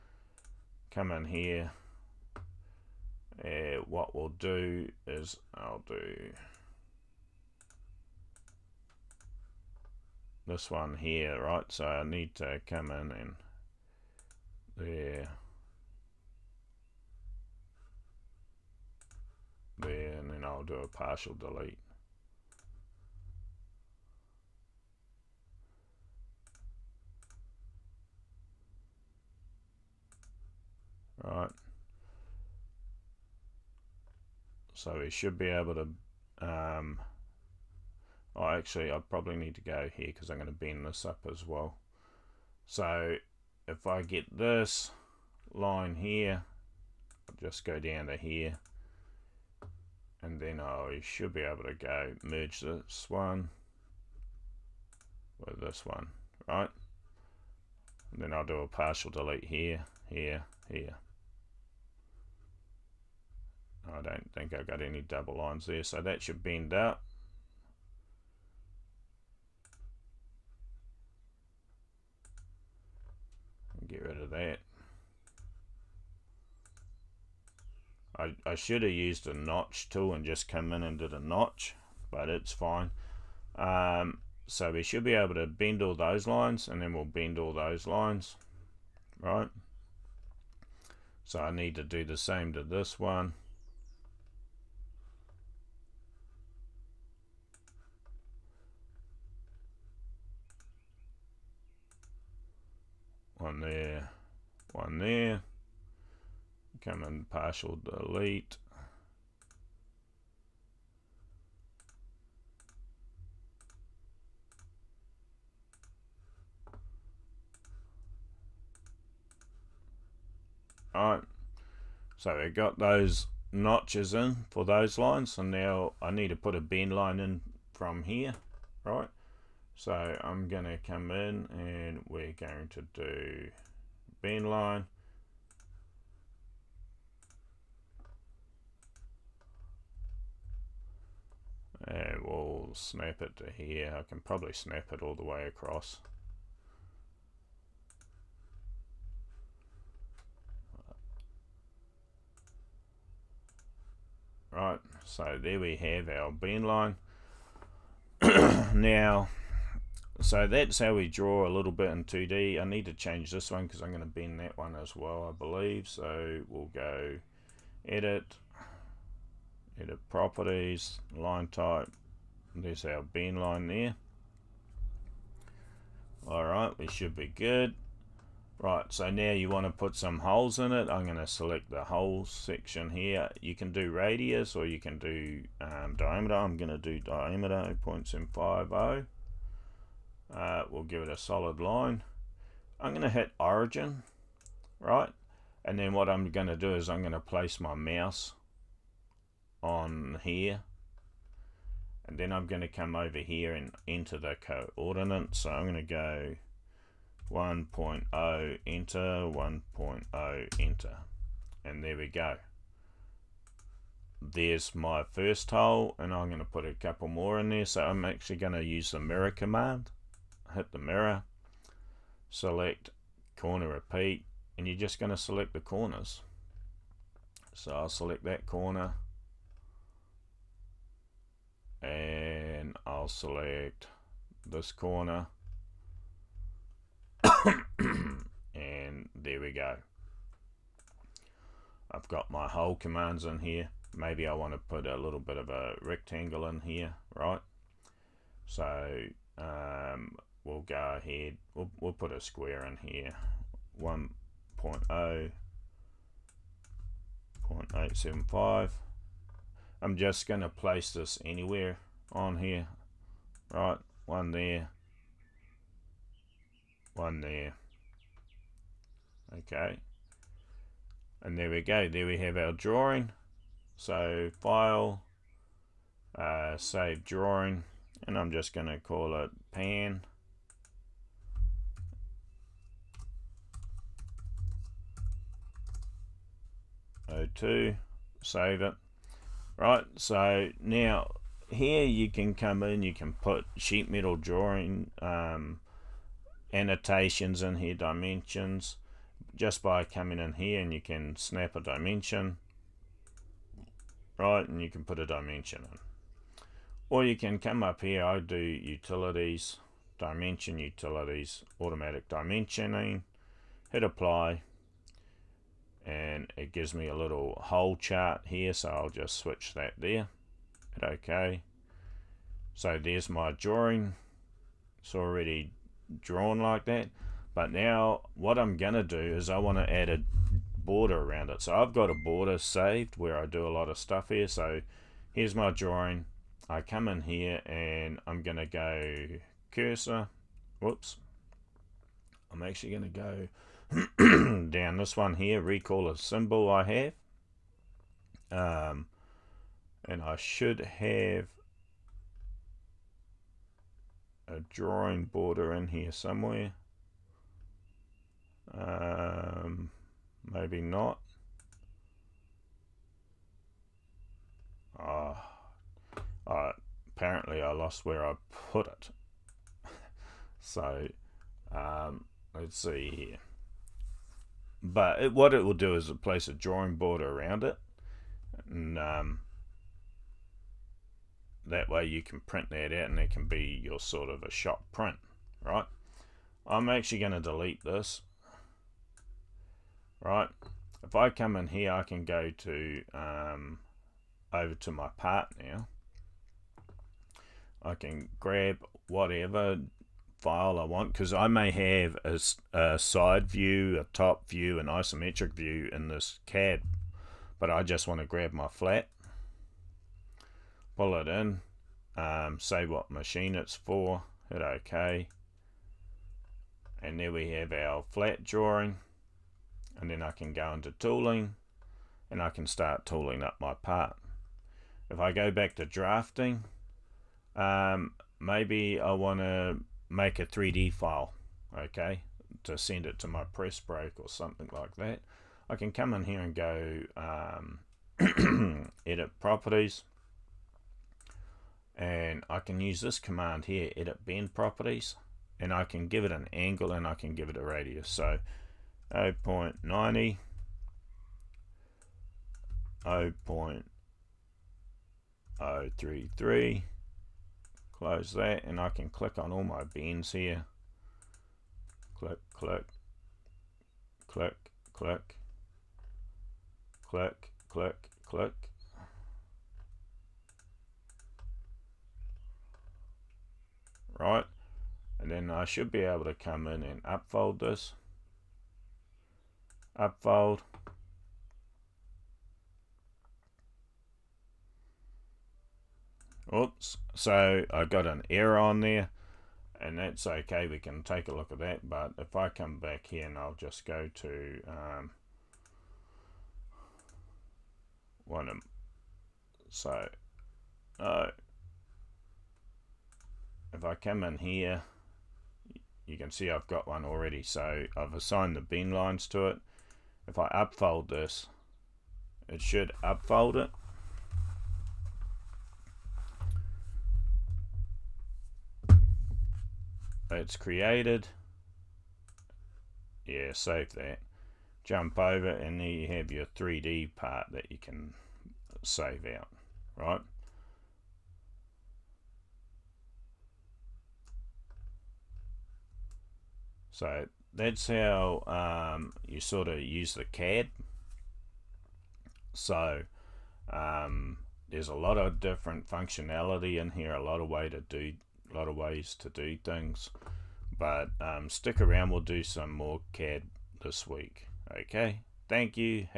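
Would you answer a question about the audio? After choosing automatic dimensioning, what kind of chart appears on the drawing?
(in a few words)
hole chart.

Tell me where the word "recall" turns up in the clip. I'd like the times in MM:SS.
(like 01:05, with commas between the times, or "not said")
05:45.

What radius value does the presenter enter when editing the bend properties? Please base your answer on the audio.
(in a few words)
0.033.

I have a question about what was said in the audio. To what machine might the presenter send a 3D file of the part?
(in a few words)
press break.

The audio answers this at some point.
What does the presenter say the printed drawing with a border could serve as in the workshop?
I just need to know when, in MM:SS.
06:24.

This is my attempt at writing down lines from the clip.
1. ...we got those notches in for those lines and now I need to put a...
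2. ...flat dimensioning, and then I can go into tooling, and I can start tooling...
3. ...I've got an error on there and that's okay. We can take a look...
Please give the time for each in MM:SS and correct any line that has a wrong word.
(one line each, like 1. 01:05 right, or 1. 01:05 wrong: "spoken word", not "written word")
1. 02:02 right
2. 06:57 wrong: "drawing", not "dimensioning"
3. 08:07 right.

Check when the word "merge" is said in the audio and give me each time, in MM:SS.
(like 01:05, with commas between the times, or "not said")
00:52.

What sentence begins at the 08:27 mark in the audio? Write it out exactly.
So I've assigned the bend lines to it.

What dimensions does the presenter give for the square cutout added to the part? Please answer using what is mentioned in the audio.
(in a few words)
1.0, 0.875.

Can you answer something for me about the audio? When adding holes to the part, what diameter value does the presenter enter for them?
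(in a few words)
0.750.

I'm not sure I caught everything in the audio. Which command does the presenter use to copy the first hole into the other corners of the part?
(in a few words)
mirror command.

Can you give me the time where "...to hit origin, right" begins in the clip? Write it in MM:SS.
03:13.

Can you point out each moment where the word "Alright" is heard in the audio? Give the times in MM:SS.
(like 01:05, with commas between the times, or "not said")
02:00, 02:56.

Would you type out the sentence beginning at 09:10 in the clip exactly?
But um, stick around, we'll do some more CAD this week.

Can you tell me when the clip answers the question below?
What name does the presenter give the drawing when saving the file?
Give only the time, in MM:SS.
04:39.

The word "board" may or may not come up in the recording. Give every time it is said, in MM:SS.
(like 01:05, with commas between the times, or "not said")
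06:16.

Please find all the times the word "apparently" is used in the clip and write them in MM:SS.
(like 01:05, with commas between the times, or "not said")
06:06.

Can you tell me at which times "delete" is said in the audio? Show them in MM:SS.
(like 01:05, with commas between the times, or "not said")
00:21, 00:59, 01:47, 06:27.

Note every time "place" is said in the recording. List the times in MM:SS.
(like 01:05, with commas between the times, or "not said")
03:17, 04:20, 06:16.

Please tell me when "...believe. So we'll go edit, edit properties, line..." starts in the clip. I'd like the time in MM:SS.
02:45.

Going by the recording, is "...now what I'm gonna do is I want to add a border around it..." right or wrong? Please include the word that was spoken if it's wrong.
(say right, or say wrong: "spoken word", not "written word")
right.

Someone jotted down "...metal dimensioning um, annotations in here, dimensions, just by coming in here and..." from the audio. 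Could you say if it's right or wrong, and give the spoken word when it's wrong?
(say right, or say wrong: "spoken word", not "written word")
wrong: "drawing", not "dimensioning".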